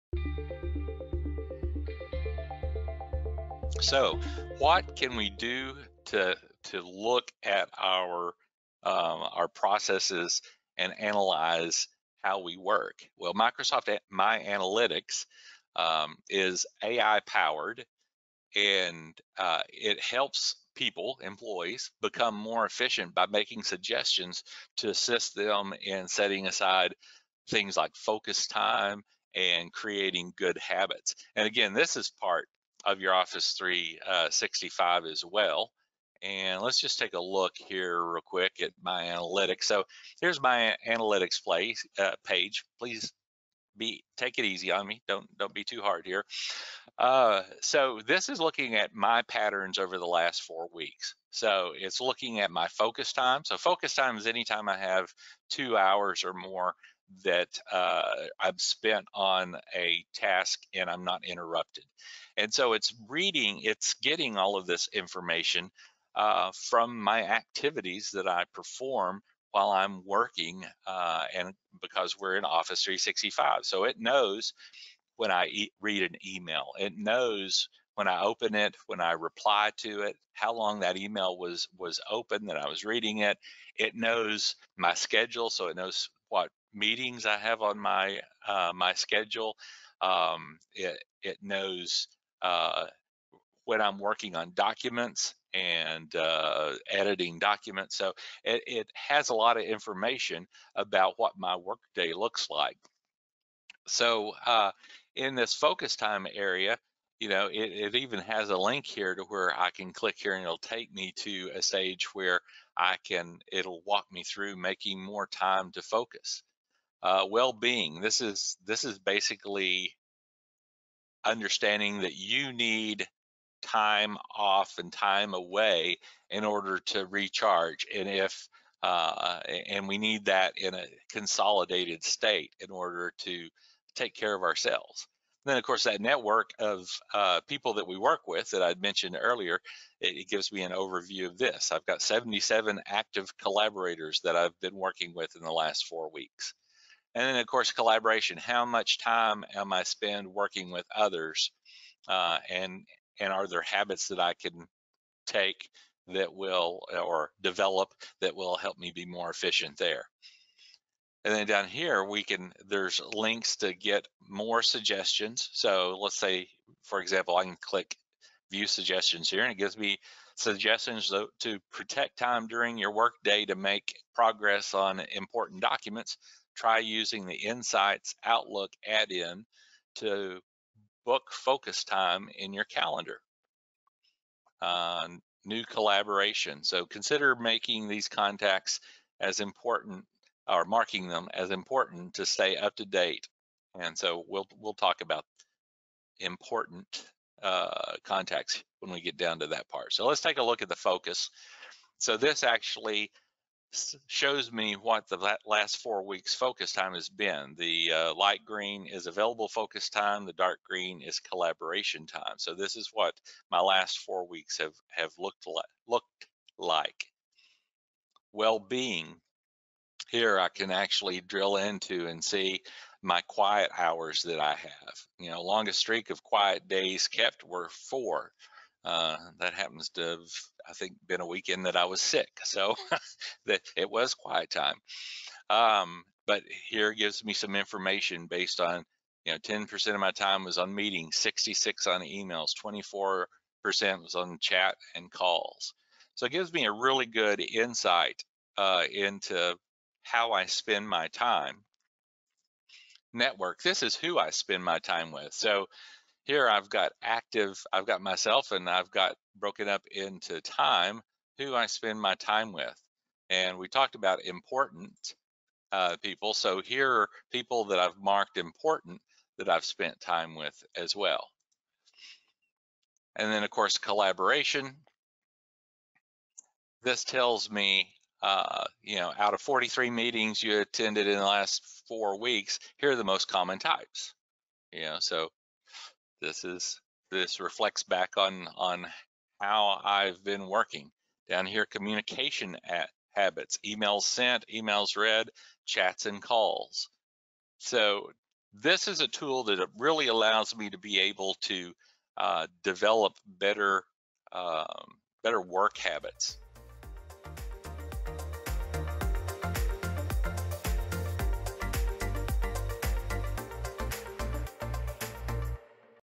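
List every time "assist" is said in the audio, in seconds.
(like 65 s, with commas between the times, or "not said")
24 s.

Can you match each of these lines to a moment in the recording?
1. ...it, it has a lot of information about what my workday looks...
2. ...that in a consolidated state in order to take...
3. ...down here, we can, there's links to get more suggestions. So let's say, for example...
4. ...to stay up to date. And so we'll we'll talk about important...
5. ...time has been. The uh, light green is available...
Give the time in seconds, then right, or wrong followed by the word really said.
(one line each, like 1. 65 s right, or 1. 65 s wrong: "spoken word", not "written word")
1. 98 s right
2. 130 s right
3. 161 s right
4. 192 s right
5. 206 s right.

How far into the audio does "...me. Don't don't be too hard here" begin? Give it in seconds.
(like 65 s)
44 s.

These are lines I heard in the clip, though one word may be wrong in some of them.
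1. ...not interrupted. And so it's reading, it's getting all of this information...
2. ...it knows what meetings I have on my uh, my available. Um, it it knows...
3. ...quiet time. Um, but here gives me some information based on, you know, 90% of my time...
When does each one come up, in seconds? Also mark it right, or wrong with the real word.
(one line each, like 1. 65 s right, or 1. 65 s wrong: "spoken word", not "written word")
1. 61 s right
2. 85 s wrong: "schedule", not "available"
3. 234 s wrong: "10", not "90".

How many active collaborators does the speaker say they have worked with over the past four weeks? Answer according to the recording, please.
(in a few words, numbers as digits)
77.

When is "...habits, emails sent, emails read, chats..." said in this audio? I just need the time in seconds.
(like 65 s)
293 s.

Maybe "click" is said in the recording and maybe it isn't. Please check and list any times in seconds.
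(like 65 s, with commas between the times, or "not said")
109 s, 167 s.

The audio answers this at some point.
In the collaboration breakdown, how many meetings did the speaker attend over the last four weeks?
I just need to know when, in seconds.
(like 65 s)
279 s.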